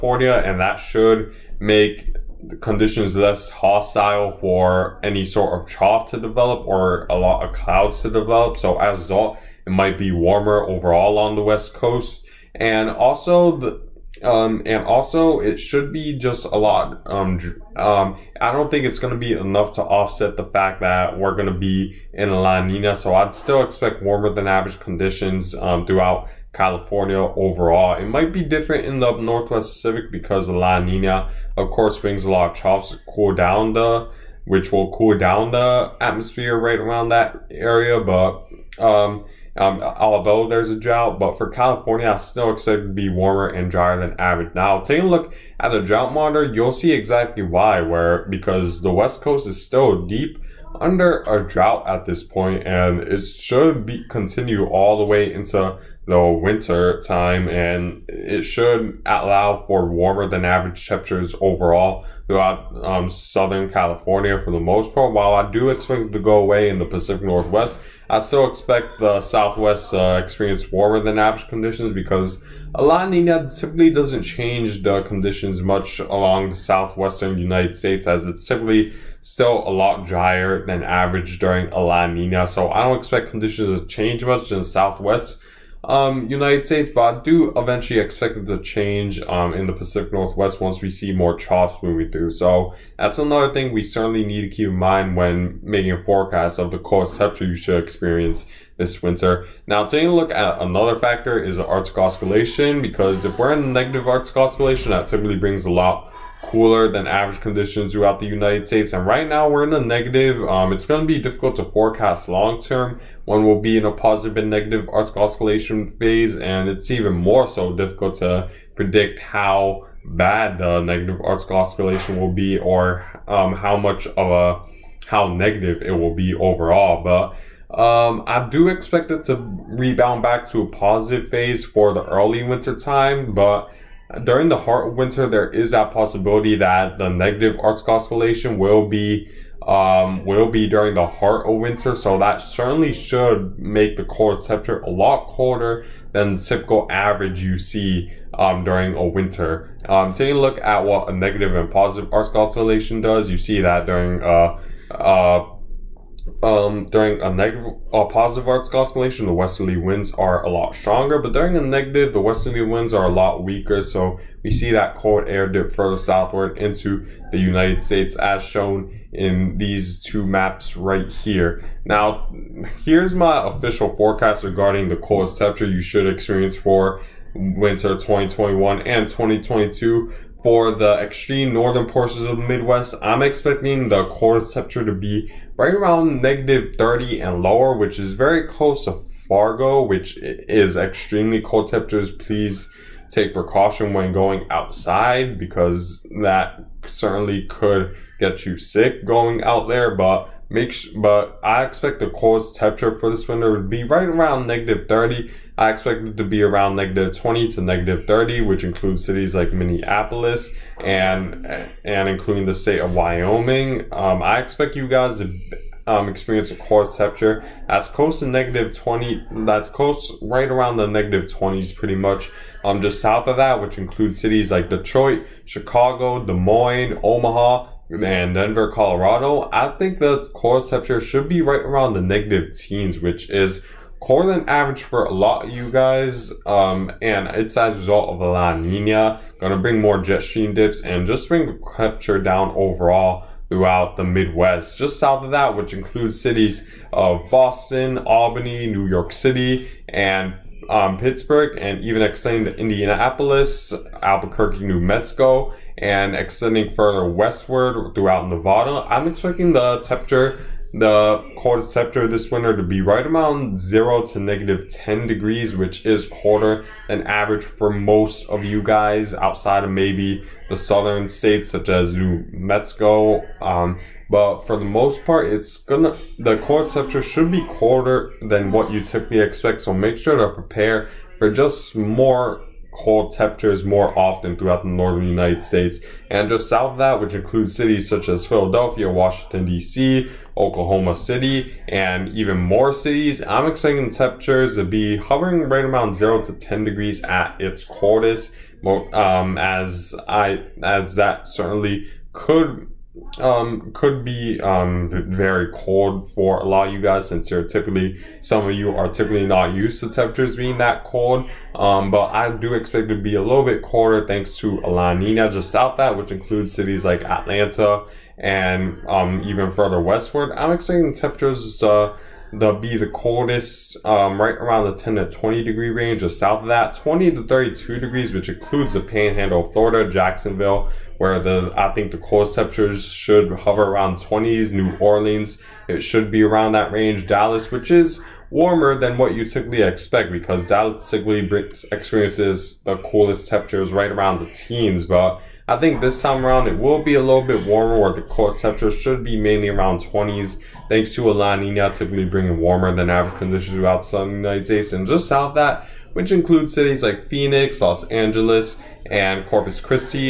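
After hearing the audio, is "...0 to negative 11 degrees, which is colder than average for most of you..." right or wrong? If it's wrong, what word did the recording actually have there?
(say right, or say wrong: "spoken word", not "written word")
wrong: "10", not "11".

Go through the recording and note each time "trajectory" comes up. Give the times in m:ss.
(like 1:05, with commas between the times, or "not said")
not said.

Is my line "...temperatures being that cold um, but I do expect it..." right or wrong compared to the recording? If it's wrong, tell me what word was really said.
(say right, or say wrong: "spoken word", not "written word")
right.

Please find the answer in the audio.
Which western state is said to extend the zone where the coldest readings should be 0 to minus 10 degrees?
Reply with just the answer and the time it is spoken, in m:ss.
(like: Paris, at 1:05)
Nevada, at 4:18.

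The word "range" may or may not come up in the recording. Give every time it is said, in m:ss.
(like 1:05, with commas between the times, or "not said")
5:25, 5:36.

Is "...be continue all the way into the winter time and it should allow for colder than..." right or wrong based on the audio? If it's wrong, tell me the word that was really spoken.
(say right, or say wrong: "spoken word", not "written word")
wrong: "warmer", not "colder".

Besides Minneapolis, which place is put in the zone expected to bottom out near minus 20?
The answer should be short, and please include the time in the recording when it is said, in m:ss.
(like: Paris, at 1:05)
Wyoming, at 3:32.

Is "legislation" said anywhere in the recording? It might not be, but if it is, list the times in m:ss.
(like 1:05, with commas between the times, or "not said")
not said.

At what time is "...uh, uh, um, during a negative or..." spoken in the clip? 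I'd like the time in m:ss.
2:34.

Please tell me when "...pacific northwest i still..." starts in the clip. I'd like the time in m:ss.
1:06.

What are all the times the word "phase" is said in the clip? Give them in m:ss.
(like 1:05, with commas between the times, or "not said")
1:55, 2:11.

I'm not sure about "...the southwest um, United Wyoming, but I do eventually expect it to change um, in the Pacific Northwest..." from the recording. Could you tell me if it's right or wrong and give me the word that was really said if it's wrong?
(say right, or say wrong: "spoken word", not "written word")
wrong: "States", not "Wyoming".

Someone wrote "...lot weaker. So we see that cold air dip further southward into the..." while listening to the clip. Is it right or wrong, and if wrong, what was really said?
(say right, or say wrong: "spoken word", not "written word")
right.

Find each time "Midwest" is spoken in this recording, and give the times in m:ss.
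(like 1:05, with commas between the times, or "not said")
3:02, 4:04.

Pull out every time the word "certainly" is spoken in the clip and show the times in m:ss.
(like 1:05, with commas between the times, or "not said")
1:33, 2:22, 3:16, 5:01.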